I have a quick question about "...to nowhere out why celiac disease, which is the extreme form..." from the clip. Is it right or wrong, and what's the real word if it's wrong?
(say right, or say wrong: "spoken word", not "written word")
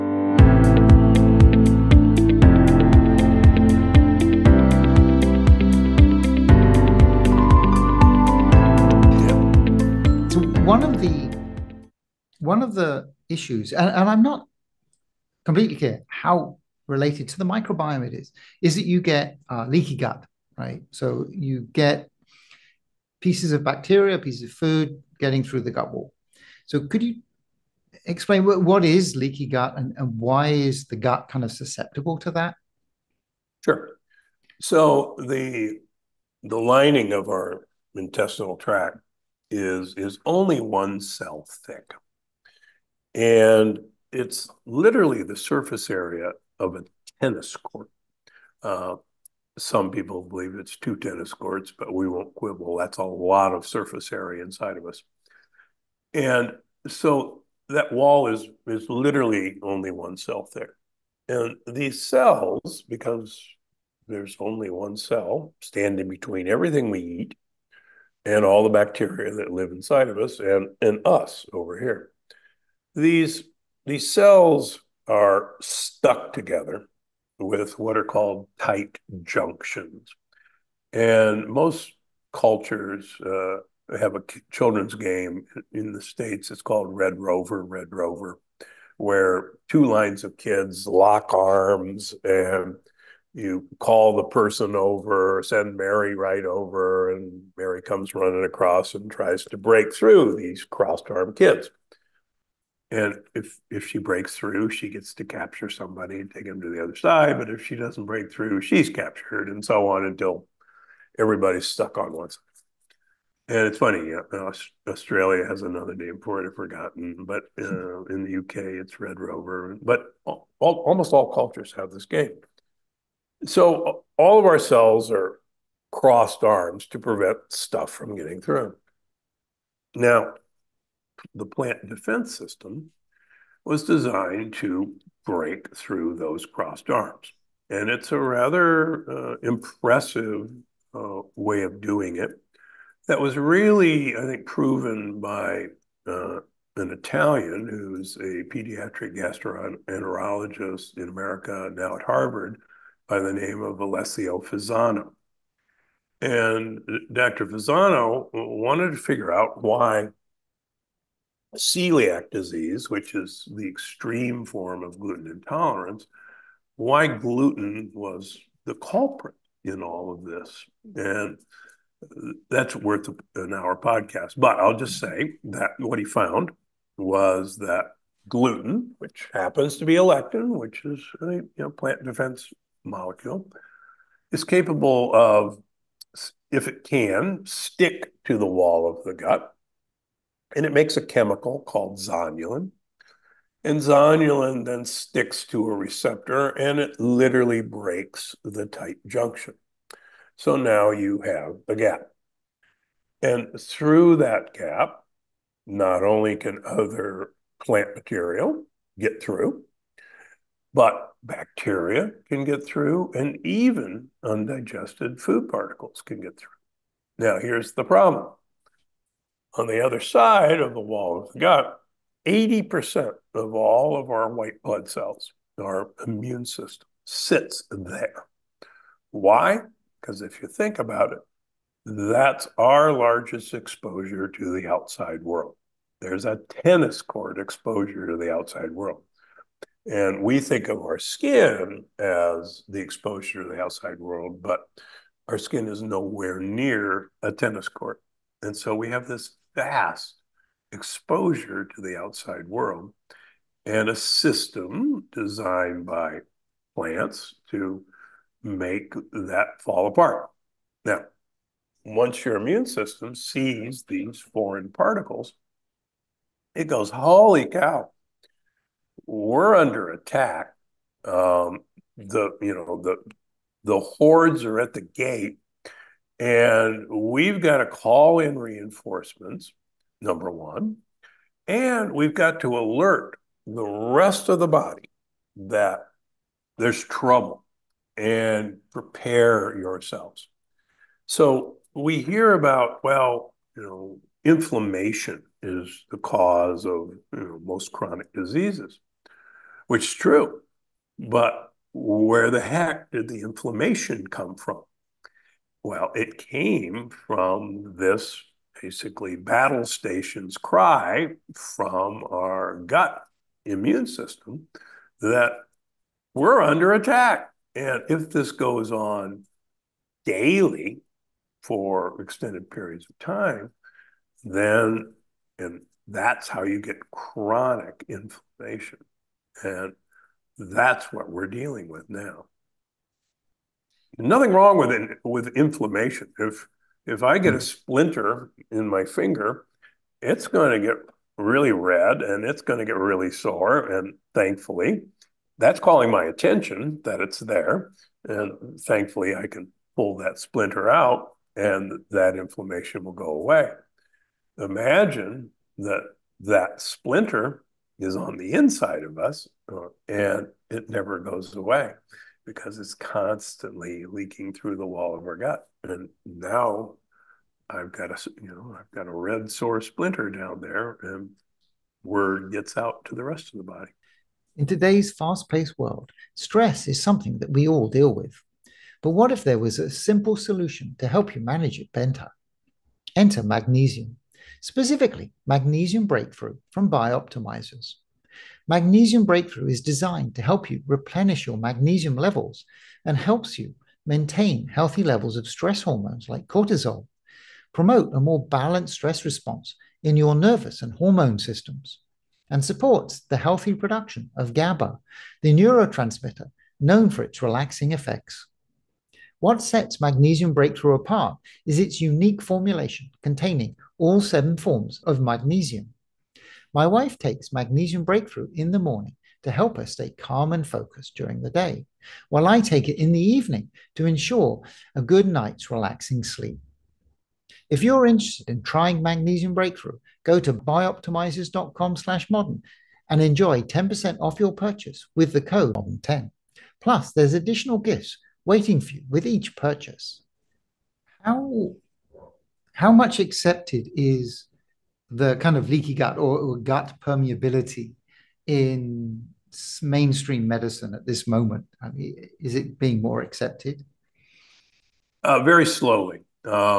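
wrong: "figure", not "nowhere".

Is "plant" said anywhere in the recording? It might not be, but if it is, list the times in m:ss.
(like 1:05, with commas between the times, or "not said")
2:11, 3:01, 3:27, 4:16.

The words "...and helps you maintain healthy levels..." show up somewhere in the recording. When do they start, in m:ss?
6:32.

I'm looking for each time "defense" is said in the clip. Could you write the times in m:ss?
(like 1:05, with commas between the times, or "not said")
2:11, 3:02.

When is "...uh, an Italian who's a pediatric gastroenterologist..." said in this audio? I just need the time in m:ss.
2:26.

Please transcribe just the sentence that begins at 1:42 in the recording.
And if if she breaks through, she gets to capture somebody and take him to the other side.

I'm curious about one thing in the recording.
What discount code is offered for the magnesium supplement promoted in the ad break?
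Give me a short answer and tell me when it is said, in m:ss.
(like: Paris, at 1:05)
modern10, at 7:15.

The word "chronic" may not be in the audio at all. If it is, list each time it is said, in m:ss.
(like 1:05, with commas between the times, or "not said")
4:57, 5:26.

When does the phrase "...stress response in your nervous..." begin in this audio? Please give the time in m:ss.
6:38.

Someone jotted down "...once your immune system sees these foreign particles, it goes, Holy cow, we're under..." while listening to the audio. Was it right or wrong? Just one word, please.
right.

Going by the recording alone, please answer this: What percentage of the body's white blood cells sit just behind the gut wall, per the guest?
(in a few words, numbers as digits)
80%.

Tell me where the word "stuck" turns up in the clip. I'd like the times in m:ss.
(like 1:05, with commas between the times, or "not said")
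1:15, 1:51.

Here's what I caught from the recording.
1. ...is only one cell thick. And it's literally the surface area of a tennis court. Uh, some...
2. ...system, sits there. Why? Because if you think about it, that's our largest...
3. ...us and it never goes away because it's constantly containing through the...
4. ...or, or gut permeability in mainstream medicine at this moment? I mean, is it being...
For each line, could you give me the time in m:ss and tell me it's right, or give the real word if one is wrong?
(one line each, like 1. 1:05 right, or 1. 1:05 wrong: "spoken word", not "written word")
1. 0:39 right
2. 3:46 right
3. 5:58 wrong: "leaking", not "containing"
4. 7:25 right.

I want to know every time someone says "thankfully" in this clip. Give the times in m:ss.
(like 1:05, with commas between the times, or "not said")
5:44, 5:48.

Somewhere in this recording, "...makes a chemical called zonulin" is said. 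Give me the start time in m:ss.
3:10.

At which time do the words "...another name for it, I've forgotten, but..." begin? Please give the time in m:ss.
1:55.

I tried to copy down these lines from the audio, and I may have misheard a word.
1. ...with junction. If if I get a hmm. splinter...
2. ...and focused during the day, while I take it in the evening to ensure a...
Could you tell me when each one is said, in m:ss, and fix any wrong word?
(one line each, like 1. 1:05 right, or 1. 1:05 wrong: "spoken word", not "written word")
1. 5:35 wrong: "inflammation", not "junction"
2. 7:00 right.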